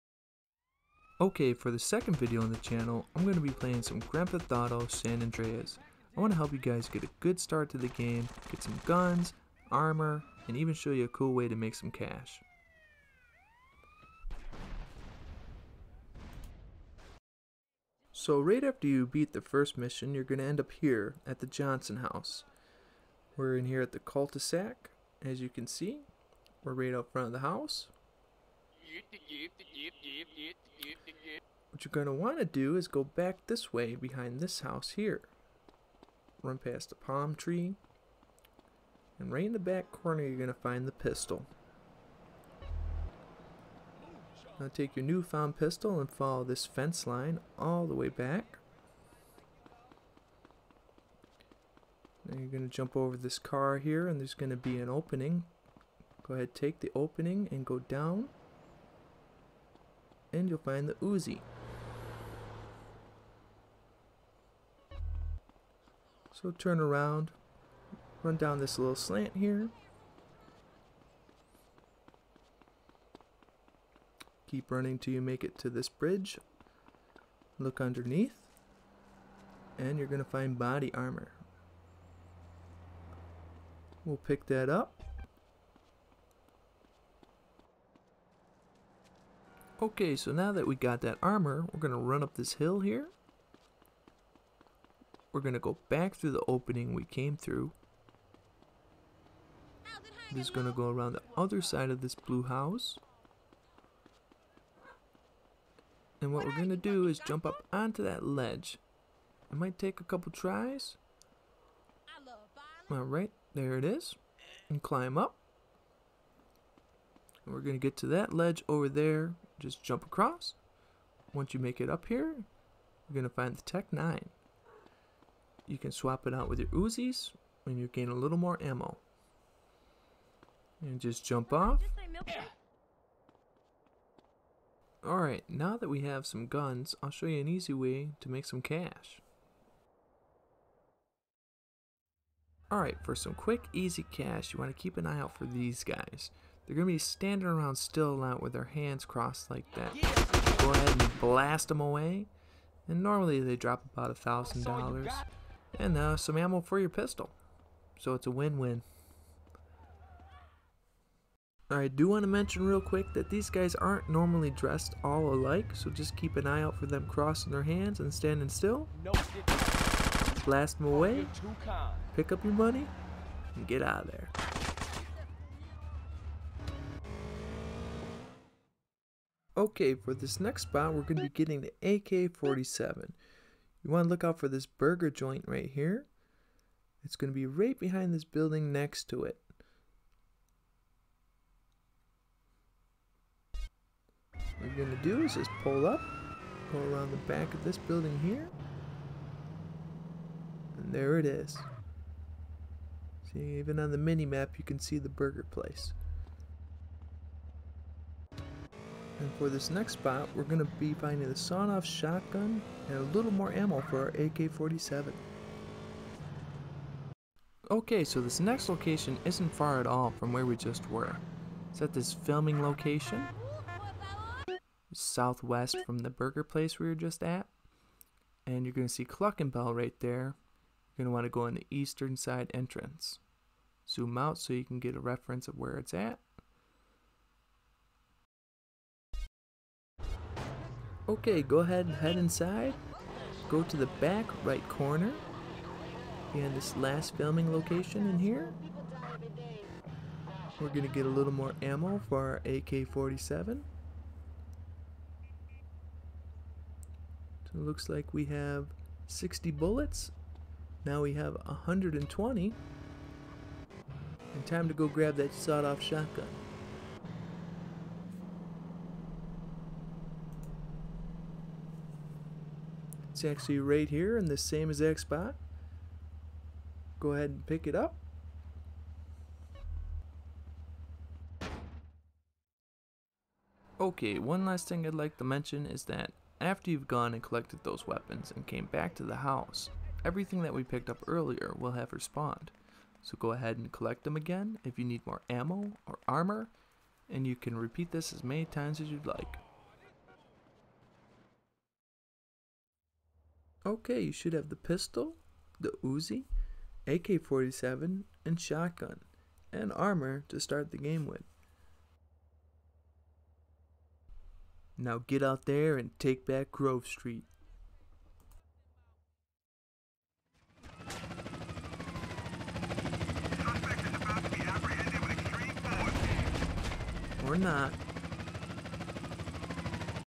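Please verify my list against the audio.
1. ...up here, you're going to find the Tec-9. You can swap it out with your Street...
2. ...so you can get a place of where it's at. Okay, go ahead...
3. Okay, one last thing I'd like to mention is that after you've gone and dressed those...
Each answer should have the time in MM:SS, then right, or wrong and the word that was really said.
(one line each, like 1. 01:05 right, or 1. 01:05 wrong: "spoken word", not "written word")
1. 02:01 wrong: "Uzis", not "Street"
2. 03:54 wrong: "reference", not "place"
3. 04:43 wrong: "collected", not "dressed".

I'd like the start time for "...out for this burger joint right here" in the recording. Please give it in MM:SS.
03:04.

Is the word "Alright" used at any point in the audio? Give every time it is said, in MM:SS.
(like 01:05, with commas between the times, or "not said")
01:52, 02:15, 02:22.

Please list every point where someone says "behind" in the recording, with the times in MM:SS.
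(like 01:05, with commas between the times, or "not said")
00:33, 03:07.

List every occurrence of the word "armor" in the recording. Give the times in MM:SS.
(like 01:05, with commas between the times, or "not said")
00:09, 01:20, 01:31, 04:56, 05:09.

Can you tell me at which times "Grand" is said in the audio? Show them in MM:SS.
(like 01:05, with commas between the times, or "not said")
00:04.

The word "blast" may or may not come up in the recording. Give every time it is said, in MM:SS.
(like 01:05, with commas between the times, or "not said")
02:31, 02:50.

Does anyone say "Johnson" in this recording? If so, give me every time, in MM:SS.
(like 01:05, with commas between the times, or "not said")
00:21.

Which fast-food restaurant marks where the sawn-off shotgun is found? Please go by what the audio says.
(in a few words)
Cluckin' Bell.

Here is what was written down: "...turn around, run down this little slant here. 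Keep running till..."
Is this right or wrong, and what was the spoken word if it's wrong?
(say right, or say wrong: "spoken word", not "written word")
right.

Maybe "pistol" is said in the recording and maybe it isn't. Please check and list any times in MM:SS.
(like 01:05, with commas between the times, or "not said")
00:40, 00:45, 02:36, 05:04.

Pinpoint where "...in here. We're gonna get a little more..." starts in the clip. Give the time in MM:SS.
04:08.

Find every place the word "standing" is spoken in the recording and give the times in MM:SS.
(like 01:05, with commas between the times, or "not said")
02:26, 02:48.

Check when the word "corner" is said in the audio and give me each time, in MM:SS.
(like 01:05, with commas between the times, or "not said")
00:39, 04:04.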